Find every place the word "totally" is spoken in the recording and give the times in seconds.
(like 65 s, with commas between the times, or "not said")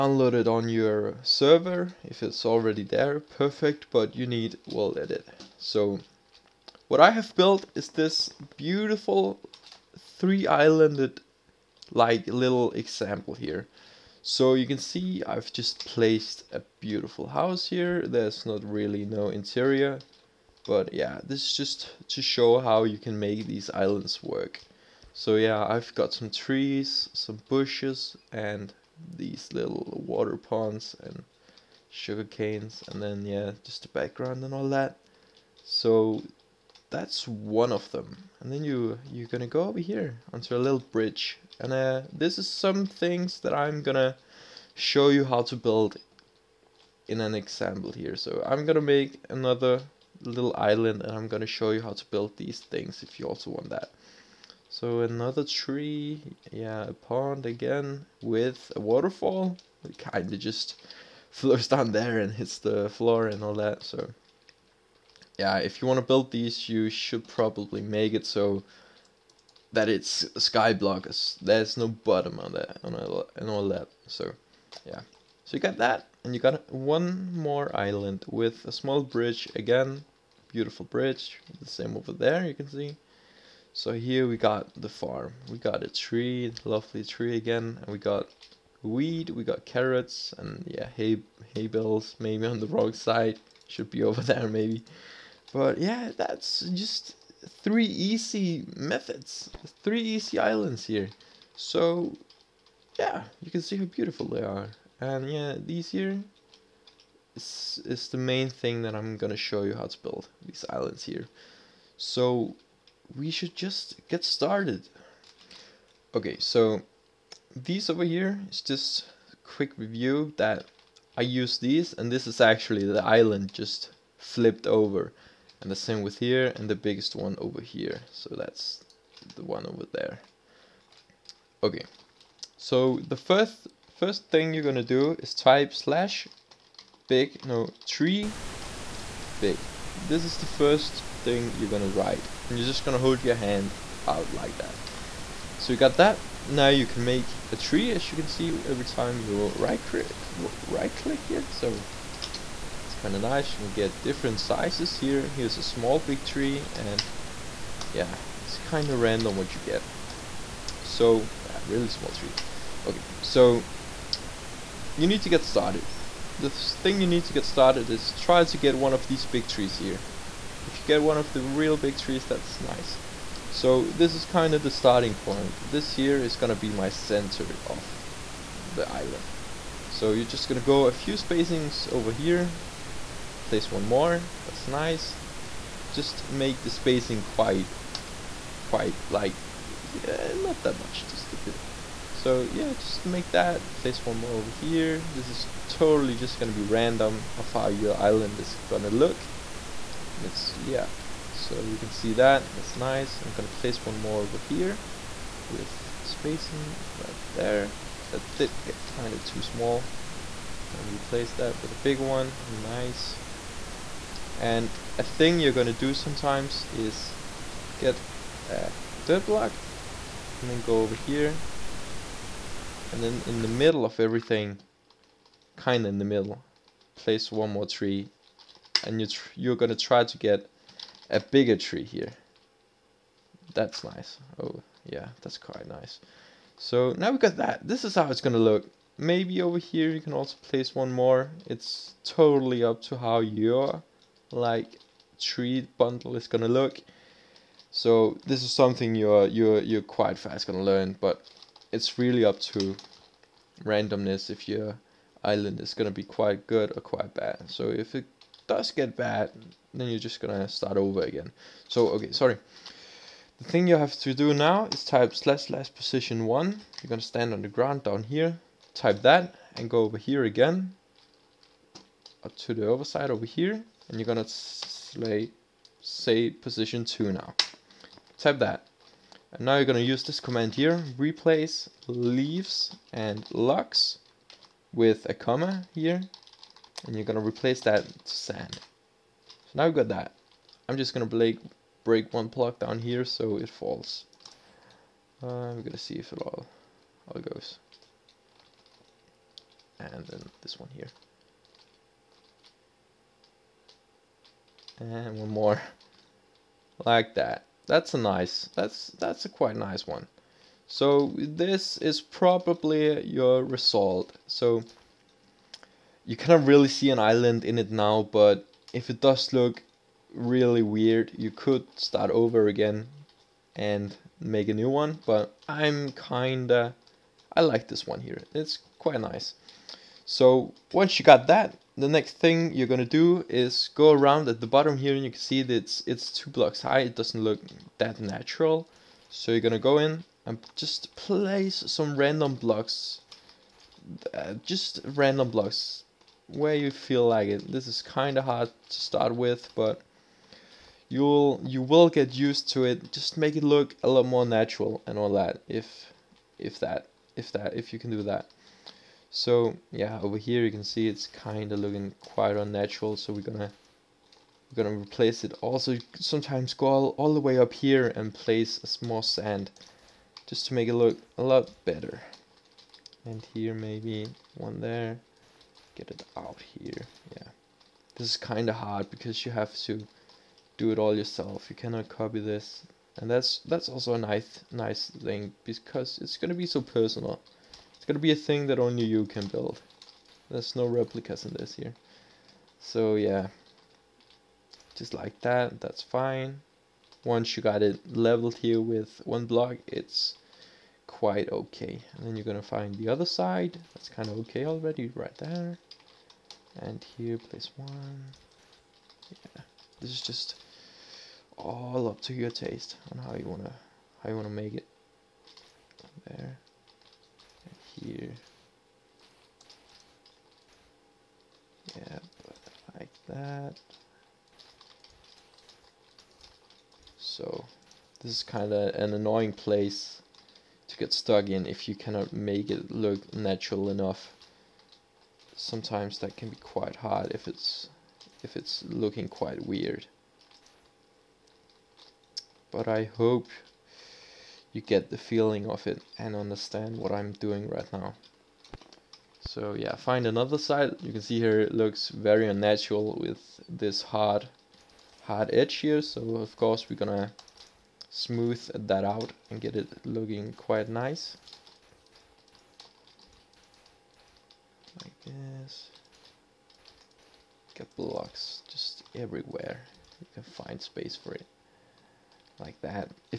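195 s, 242 s.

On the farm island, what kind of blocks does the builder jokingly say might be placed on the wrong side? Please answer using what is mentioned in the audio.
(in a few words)
Hay bales.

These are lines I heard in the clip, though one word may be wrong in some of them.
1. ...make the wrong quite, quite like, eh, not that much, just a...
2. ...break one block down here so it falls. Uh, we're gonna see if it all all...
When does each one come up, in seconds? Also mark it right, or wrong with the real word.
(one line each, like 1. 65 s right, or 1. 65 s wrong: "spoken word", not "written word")
1. 186 s wrong: "spacing", not "wrong"
2. 291 s right.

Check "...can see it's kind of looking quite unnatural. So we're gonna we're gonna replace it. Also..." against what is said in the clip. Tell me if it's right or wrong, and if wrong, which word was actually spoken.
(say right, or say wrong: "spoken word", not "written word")
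right.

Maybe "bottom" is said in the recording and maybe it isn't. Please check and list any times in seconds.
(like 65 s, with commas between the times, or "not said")
71 s, 334 s.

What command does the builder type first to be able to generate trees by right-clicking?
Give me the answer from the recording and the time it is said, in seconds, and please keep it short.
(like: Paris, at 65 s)
/tree big, at 137 s.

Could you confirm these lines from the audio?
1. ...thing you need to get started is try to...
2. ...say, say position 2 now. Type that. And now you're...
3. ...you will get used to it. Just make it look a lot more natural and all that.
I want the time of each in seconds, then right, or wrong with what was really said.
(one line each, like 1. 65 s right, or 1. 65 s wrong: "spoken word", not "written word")
1. 166 s right
2. 274 s right
3. 351 s right.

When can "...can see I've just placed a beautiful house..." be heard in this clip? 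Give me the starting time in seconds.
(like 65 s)
14 s.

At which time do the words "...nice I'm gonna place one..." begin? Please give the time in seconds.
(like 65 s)
202 s.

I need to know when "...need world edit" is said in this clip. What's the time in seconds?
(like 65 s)
4 s.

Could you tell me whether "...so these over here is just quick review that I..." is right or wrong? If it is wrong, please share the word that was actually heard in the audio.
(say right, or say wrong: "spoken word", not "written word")
right.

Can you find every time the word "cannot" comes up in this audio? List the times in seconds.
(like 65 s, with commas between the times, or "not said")
316 s, 381 s, 431 s.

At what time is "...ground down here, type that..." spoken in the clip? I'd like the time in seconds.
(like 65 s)
267 s.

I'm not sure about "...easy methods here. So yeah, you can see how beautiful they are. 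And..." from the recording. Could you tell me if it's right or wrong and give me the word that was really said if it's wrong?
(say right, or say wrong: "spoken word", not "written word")
wrong: "islands", not "methods".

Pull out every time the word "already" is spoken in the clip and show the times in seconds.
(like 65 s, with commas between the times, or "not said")
2 s, 404 s.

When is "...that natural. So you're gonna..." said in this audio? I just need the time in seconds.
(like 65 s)
337 s.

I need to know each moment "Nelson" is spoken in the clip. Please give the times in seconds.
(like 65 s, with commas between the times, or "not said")
not said.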